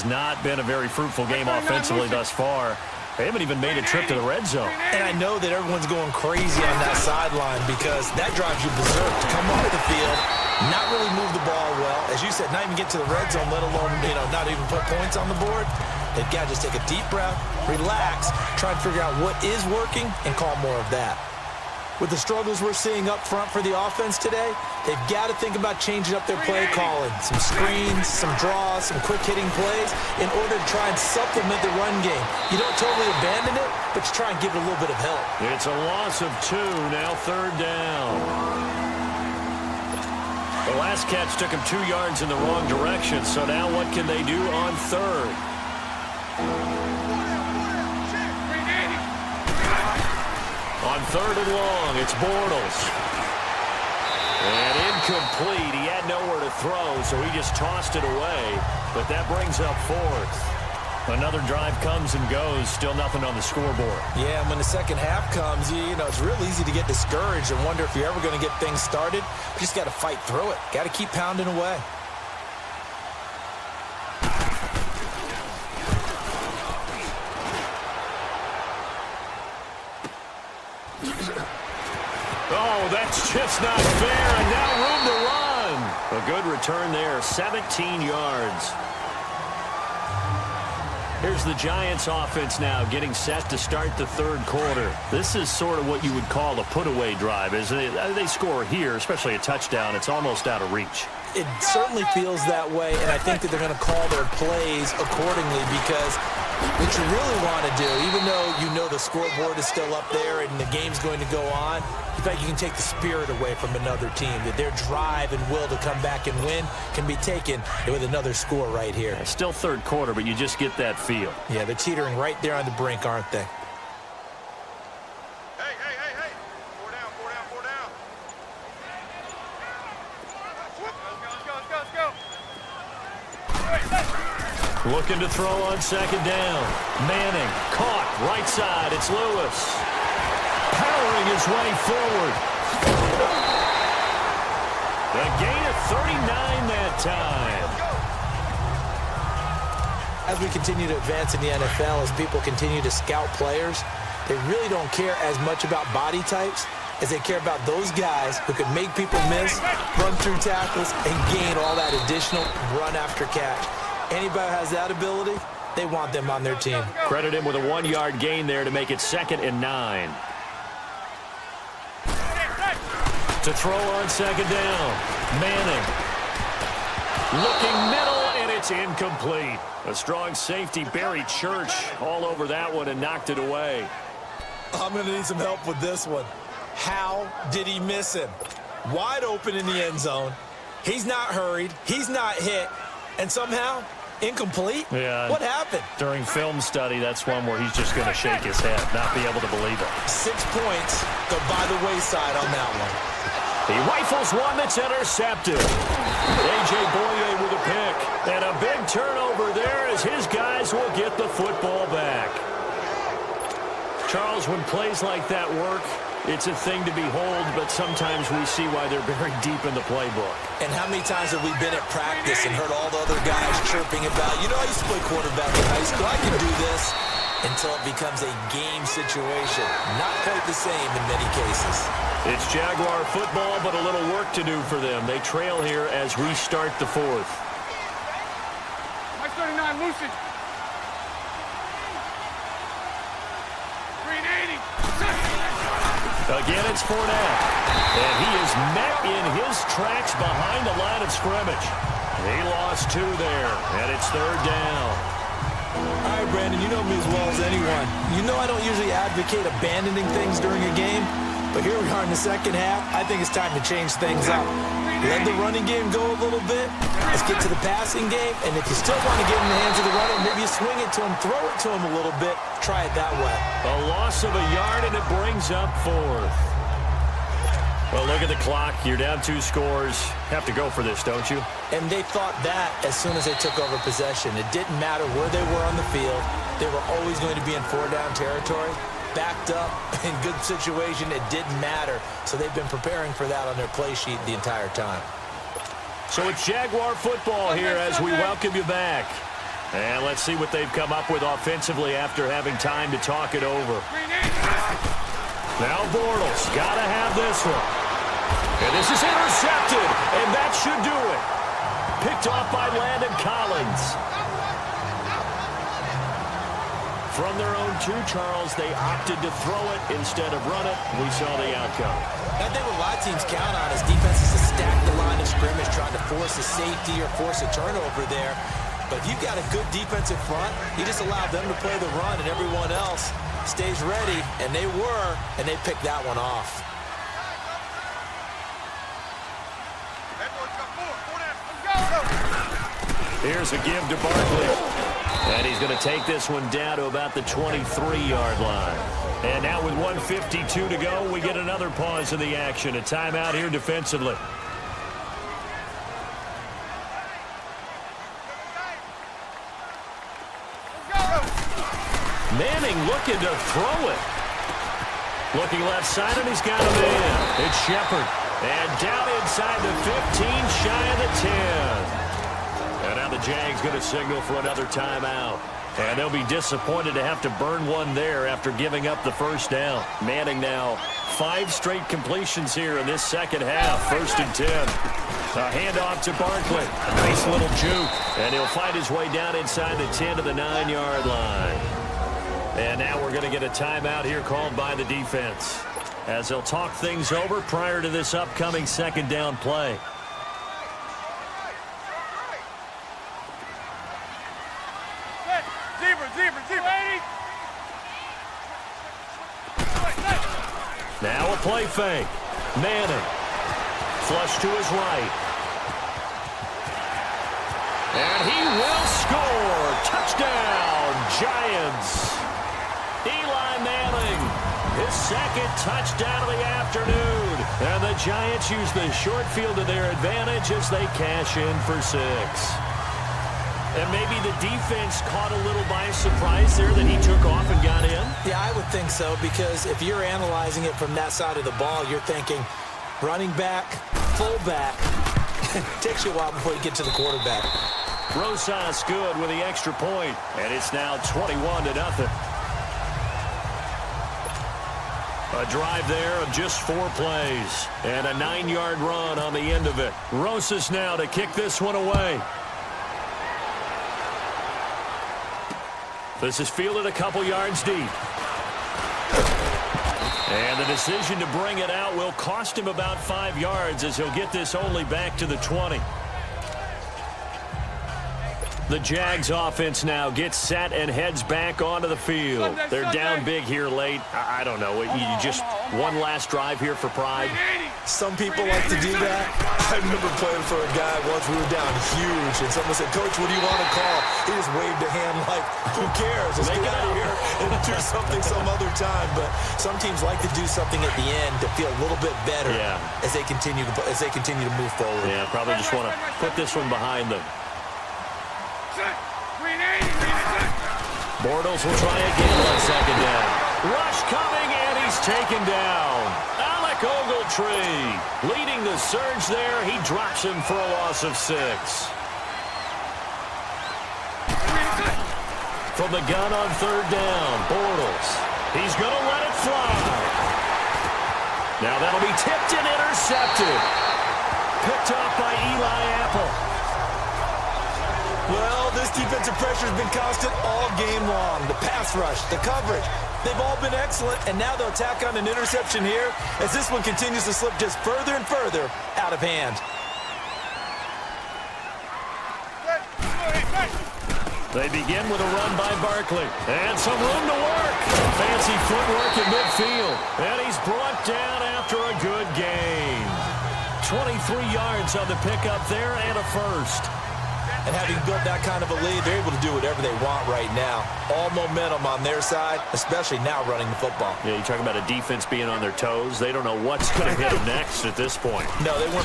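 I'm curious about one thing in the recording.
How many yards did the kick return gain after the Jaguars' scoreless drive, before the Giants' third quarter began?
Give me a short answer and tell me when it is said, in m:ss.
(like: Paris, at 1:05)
17, at 1:27.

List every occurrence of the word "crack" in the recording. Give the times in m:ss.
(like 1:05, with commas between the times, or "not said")
not said.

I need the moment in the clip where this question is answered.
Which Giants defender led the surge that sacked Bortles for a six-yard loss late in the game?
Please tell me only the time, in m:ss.
8:36.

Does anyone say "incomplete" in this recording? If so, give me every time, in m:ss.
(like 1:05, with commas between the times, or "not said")
0:54, 2:58, 3:14.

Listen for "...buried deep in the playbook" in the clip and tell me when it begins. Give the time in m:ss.
3:39.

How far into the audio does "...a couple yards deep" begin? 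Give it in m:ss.
7:46.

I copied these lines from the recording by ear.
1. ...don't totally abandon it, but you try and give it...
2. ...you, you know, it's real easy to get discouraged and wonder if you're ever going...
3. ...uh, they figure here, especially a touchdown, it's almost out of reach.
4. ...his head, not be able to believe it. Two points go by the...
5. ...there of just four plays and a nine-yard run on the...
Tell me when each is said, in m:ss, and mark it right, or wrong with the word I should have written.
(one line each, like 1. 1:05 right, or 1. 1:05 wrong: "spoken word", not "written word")
1. 0:32 right
2. 1:05 right
3. 1:37 wrong: "score", not "figure"
4. 3:18 wrong: "Six", not "Two"
5. 7:35 right.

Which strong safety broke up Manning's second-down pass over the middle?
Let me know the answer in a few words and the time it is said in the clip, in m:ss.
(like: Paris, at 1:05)
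Barry Church, at 3:00.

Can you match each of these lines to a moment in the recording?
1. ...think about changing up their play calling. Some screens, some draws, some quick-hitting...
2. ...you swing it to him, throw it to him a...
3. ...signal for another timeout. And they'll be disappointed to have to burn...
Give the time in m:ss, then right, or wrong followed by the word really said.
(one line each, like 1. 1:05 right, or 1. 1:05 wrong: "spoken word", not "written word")
1. 0:25 right
2. 4:30 right
3. 6:13 right.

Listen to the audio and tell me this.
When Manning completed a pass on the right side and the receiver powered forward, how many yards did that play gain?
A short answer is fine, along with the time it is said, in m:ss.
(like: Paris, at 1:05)
39, at 2:25.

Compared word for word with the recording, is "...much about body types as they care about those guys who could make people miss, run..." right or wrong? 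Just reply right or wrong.
right.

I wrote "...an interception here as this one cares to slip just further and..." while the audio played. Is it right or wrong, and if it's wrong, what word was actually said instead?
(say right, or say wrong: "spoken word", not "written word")
wrong: "continues", not "cares".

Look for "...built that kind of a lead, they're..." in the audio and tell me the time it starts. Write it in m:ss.
9:28.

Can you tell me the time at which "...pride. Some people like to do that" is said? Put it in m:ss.
8:06.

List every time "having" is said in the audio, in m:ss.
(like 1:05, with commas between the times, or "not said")
5:02, 9:27.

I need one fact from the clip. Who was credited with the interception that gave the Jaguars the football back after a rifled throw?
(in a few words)
A.J. Bouye.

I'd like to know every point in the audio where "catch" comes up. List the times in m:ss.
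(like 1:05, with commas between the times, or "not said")
0:41, 2:43.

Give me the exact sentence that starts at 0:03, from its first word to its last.
They haven't even made a trip to the red zone.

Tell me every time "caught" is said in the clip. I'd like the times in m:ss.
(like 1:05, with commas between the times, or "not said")
2:17, 7:15.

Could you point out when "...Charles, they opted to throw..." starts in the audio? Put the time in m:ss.
5:18.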